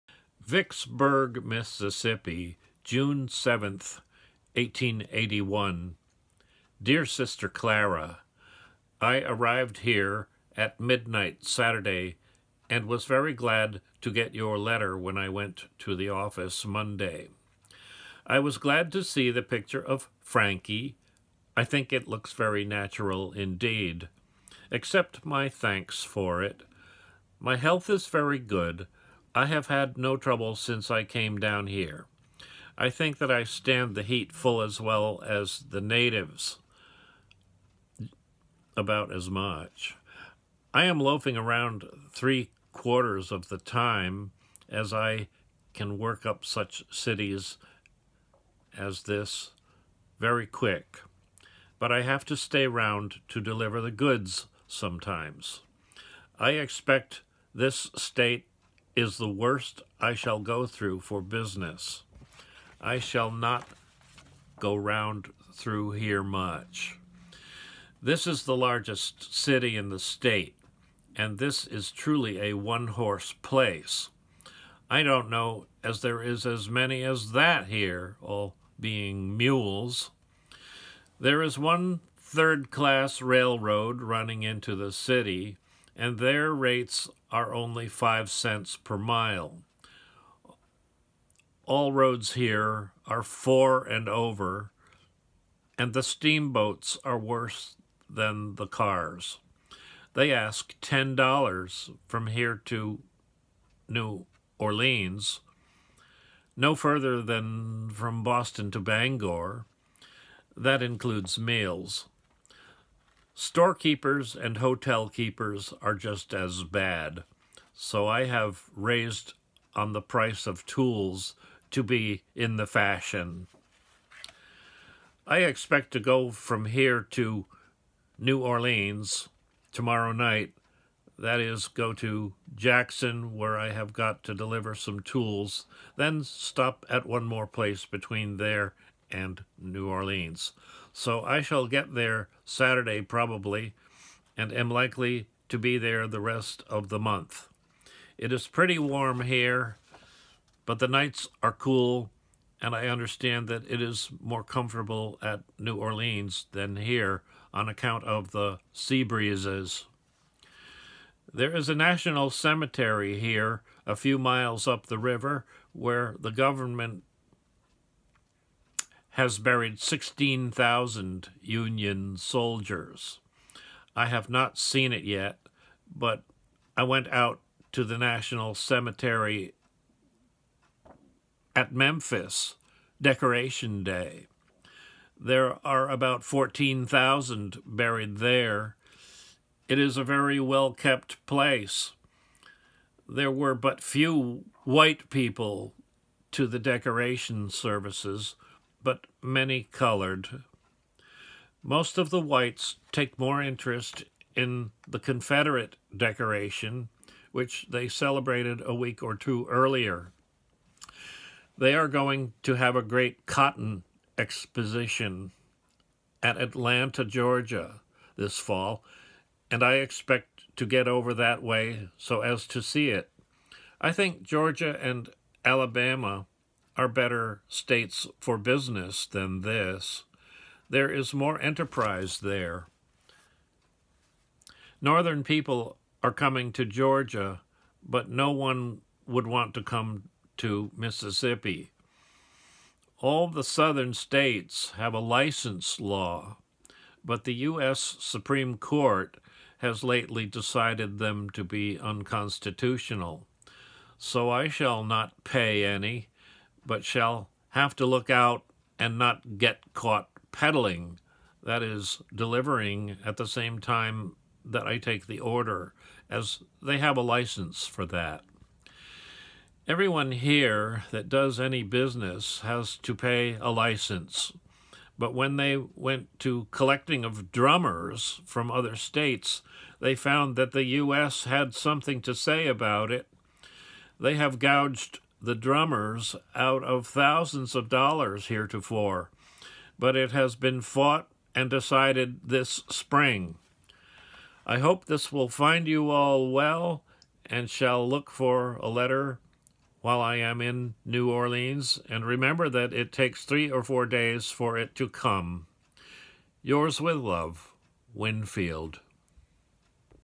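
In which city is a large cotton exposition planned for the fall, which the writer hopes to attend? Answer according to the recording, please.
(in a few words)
Atlanta, Georgia.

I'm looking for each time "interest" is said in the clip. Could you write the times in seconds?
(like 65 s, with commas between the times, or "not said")
203 s.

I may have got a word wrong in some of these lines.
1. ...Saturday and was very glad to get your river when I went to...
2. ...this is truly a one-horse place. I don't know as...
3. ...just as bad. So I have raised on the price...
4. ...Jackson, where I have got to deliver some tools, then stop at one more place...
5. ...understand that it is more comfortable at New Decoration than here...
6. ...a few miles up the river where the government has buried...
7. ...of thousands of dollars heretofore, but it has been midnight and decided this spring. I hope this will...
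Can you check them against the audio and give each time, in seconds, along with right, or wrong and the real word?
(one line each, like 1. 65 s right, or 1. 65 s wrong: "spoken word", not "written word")
1. 11 s wrong: "letter", not "river"
2. 71 s right
3. 115 s right
4. 132 s right
5. 152 s wrong: "Orleans", not "Decoration"
6. 163 s right
7. 286 s wrong: "fought", not "midnight".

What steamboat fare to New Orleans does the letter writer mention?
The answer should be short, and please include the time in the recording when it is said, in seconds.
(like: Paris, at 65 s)
$10, at 100 s.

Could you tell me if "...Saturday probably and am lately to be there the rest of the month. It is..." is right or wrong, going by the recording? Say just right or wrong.
wrong.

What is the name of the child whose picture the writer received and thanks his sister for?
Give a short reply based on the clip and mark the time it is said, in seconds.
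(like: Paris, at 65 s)
Frankie, at 20 s.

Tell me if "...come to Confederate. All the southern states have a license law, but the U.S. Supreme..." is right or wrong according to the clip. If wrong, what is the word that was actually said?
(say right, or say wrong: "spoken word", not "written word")
wrong: "Mississippi", not "Confederate".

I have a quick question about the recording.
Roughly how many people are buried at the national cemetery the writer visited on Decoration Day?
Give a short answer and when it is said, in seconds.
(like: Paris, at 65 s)
14,000, at 186 s.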